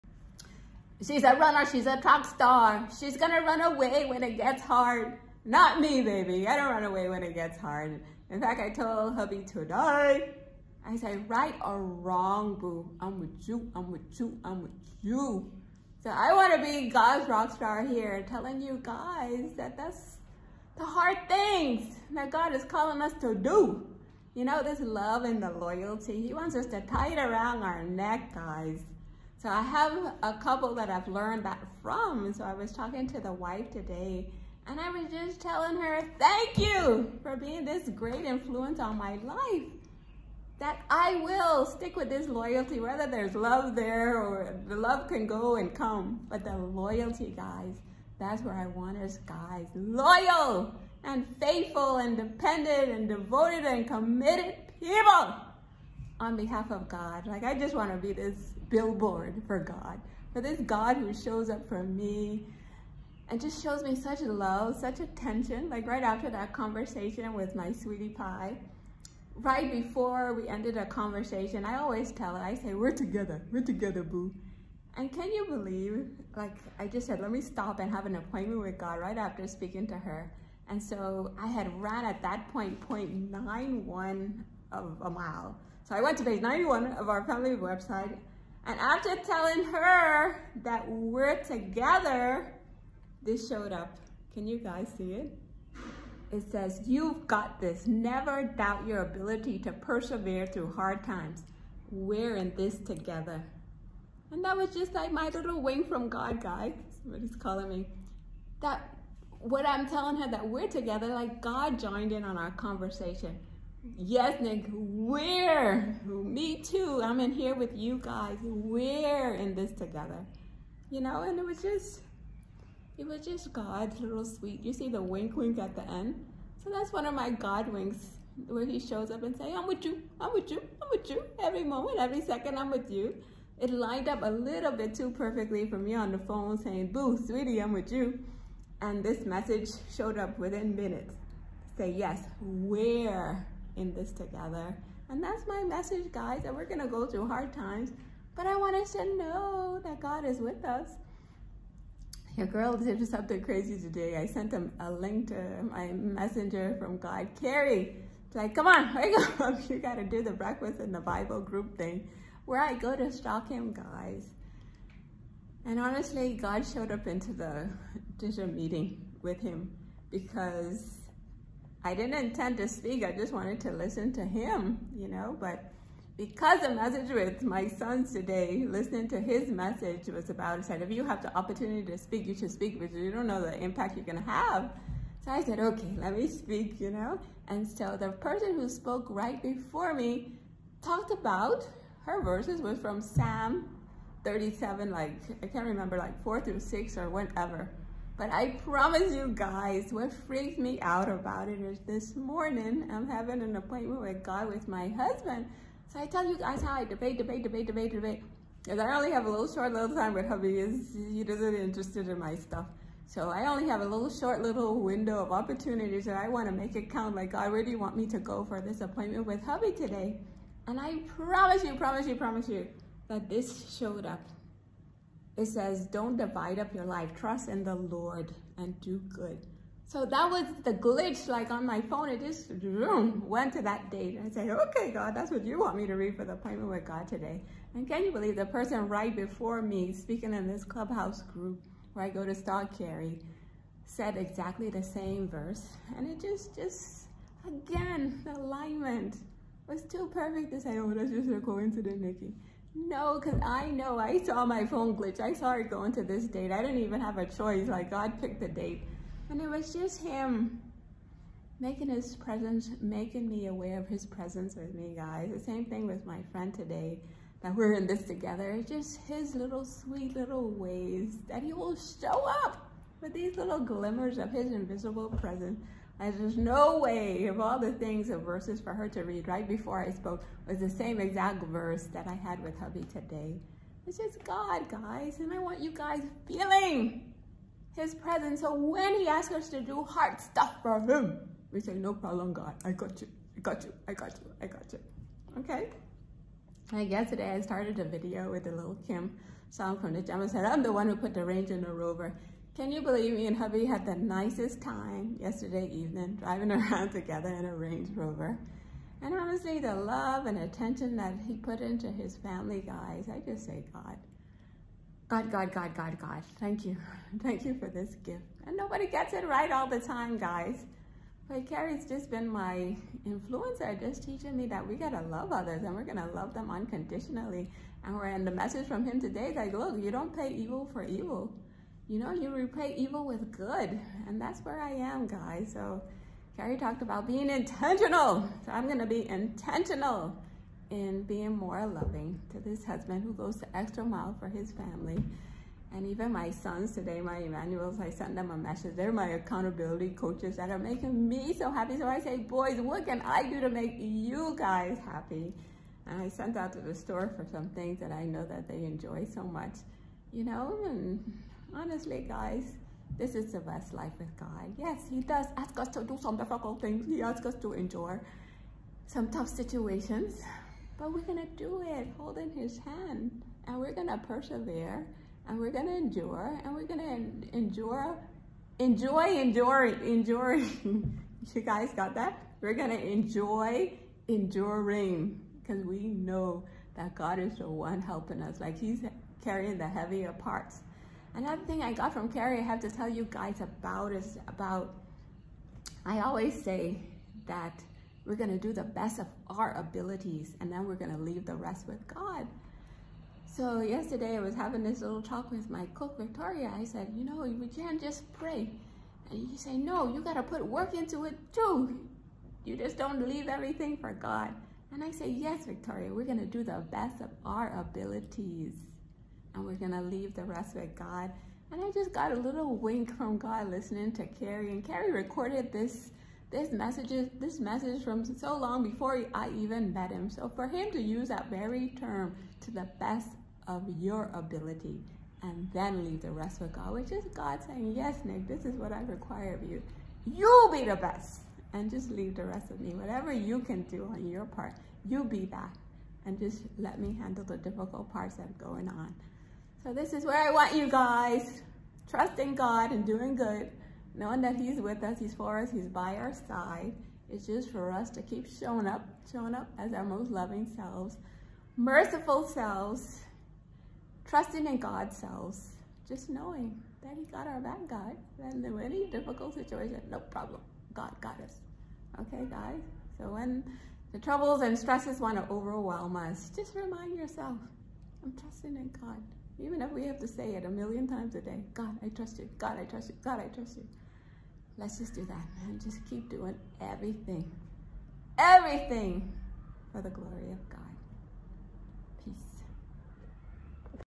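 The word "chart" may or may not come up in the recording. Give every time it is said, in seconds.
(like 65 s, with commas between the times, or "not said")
not said.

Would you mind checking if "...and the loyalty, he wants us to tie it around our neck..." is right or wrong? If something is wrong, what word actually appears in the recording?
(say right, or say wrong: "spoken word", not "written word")
right.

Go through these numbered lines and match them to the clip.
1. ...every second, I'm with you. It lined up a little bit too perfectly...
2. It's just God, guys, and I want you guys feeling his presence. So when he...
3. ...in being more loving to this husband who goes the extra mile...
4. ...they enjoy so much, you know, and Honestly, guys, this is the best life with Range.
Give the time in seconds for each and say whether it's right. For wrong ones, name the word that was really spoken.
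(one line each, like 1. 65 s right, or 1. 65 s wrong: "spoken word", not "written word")
1. 131 s right
2. 283 s right
3. 340 s right
4. 358 s wrong: "God", not "Range".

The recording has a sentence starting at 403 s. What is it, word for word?
So yesterday I was having this little talk with my cook, Victoria.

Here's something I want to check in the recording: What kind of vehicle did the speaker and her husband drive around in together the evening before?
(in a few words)
Range Rover.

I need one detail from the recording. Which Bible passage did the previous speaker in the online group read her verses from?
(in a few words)
Psalm 37.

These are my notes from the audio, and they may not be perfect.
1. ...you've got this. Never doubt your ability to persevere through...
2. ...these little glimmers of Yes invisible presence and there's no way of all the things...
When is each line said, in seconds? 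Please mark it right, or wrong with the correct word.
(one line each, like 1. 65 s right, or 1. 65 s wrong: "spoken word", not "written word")
1. 96 s right
2. 273 s wrong: "His", not "Yes".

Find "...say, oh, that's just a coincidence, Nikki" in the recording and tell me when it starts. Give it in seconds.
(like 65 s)
250 s.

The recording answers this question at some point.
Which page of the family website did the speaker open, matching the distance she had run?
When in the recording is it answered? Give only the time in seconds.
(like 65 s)
86 s.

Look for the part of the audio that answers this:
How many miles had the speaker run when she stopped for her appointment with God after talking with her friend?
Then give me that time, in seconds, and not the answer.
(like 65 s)
82 s.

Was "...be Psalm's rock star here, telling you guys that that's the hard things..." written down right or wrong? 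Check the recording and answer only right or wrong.
wrong.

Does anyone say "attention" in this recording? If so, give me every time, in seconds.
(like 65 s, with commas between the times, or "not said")
64 s, 310 s.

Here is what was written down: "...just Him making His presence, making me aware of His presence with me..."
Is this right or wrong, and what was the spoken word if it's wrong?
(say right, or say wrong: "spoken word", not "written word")
right.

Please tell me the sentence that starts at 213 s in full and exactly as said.
So I only have a little short little window of opportunities that I want to make it count.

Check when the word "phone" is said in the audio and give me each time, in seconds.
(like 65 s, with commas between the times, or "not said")
136 s, 231 s, 254 s.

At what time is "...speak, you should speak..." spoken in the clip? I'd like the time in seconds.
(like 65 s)
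181 s.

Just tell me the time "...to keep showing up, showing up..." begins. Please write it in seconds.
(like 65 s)
457 s.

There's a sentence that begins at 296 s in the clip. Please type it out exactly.
Like yesterday, I started a video with the little Kim song from the jam.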